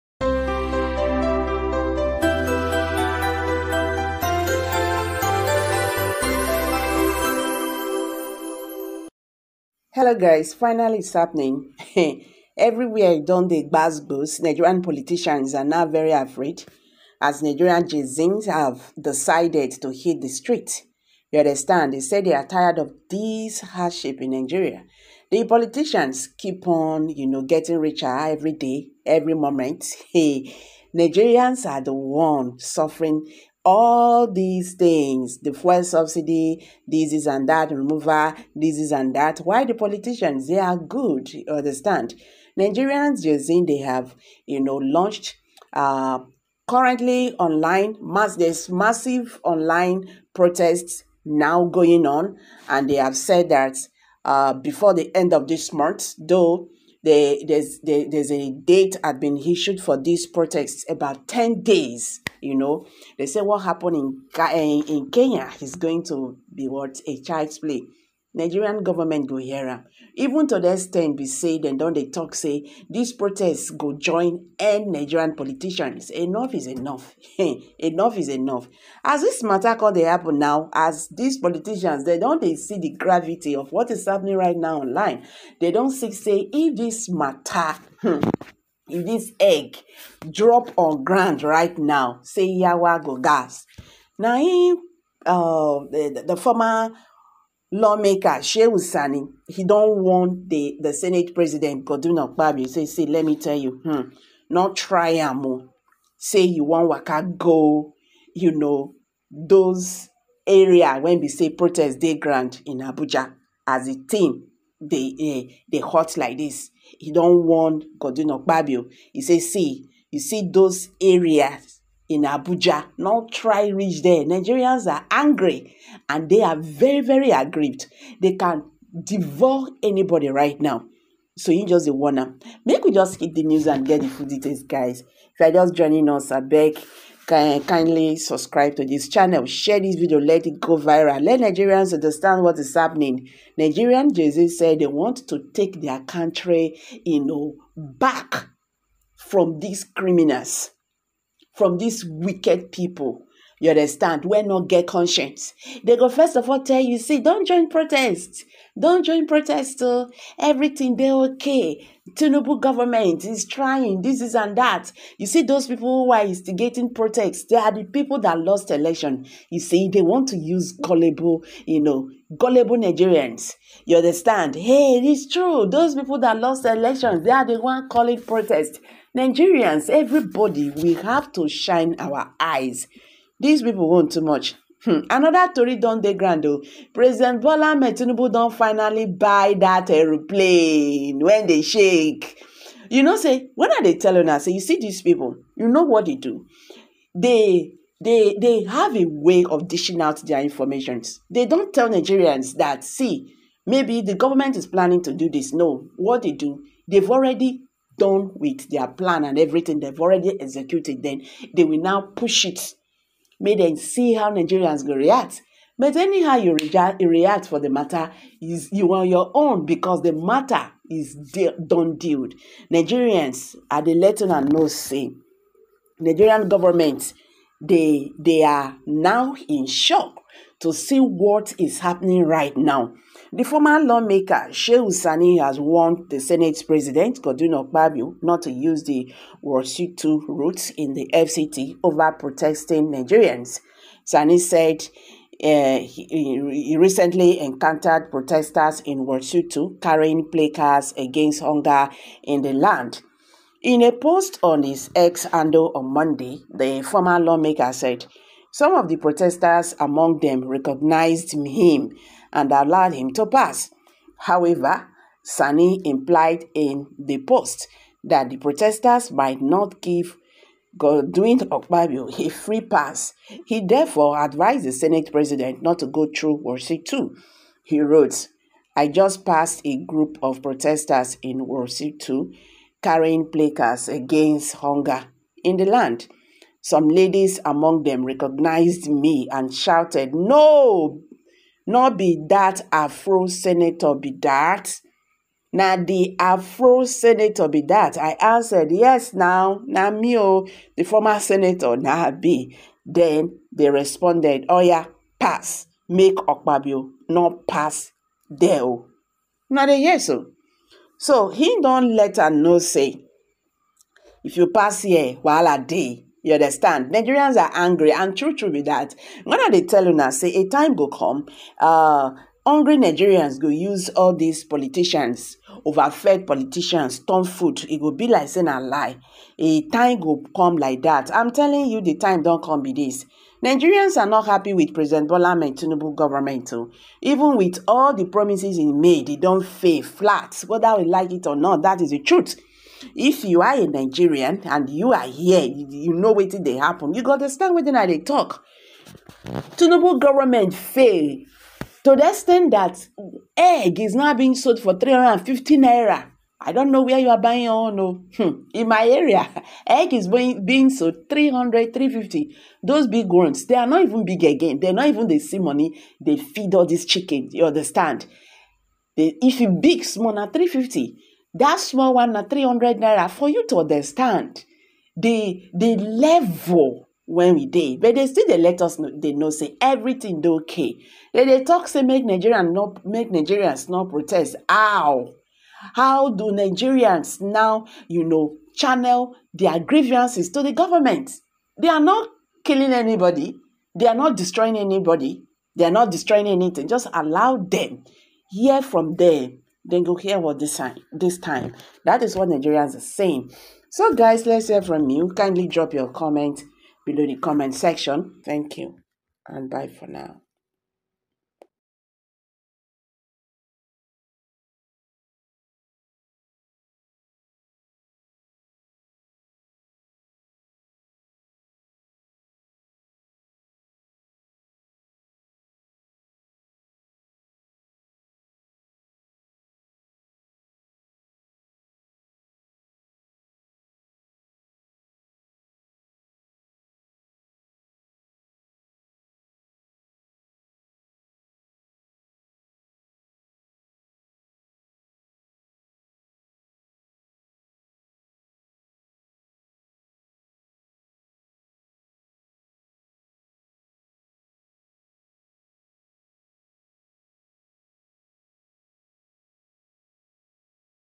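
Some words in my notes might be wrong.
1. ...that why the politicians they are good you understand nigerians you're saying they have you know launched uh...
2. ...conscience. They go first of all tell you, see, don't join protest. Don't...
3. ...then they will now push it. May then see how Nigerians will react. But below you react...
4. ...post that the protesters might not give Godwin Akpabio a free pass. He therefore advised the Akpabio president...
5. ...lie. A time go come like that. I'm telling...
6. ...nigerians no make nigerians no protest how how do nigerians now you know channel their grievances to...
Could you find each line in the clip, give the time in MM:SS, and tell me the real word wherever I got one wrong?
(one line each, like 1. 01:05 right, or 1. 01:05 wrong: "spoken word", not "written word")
1. 00:39 right
2. 02:34 right
3. 03:31 wrong: "anyhow", not "below"
4. 04:27 wrong: "Senate", not "Akpabio"
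5. 05:28 right
6. 06:22 right.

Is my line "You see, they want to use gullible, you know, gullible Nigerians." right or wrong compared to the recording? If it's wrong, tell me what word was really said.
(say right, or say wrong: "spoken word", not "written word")
right.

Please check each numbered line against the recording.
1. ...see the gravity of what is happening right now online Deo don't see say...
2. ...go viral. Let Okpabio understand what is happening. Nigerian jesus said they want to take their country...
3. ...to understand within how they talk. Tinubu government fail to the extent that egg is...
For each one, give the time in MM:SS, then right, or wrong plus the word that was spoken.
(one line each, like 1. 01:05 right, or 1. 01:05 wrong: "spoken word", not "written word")
1. 01:22 wrong: "They", not "Deo"
2. 02:20 wrong: "Nigerians", not "Okpabio"
3. 05:47 right.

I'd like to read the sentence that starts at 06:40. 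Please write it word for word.
This time, that is what Nigerians are saying.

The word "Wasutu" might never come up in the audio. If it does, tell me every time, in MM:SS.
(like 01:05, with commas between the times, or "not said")
03:59, 04:09.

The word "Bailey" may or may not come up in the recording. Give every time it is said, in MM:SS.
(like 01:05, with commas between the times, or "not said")
not said.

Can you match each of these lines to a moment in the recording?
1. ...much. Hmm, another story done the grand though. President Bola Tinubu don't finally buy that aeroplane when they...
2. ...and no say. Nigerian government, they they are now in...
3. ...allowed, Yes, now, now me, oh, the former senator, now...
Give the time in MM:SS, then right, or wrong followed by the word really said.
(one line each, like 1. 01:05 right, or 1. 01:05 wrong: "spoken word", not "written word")
1. 03:04 right
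2. 03:44 right
3. 04:58 wrong: "answered", not "allowed".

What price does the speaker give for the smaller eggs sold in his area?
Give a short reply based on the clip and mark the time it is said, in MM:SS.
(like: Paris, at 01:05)
300 naira, at 06:12.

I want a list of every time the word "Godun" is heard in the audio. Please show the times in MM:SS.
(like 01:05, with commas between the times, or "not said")
01:41, 01:57, 03:57.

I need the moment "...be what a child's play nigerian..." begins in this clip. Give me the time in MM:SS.
01:06.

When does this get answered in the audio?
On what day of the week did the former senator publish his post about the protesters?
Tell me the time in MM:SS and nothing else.
04:15.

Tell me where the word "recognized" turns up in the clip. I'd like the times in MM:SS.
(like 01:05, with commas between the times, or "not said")
04:20, 04:48.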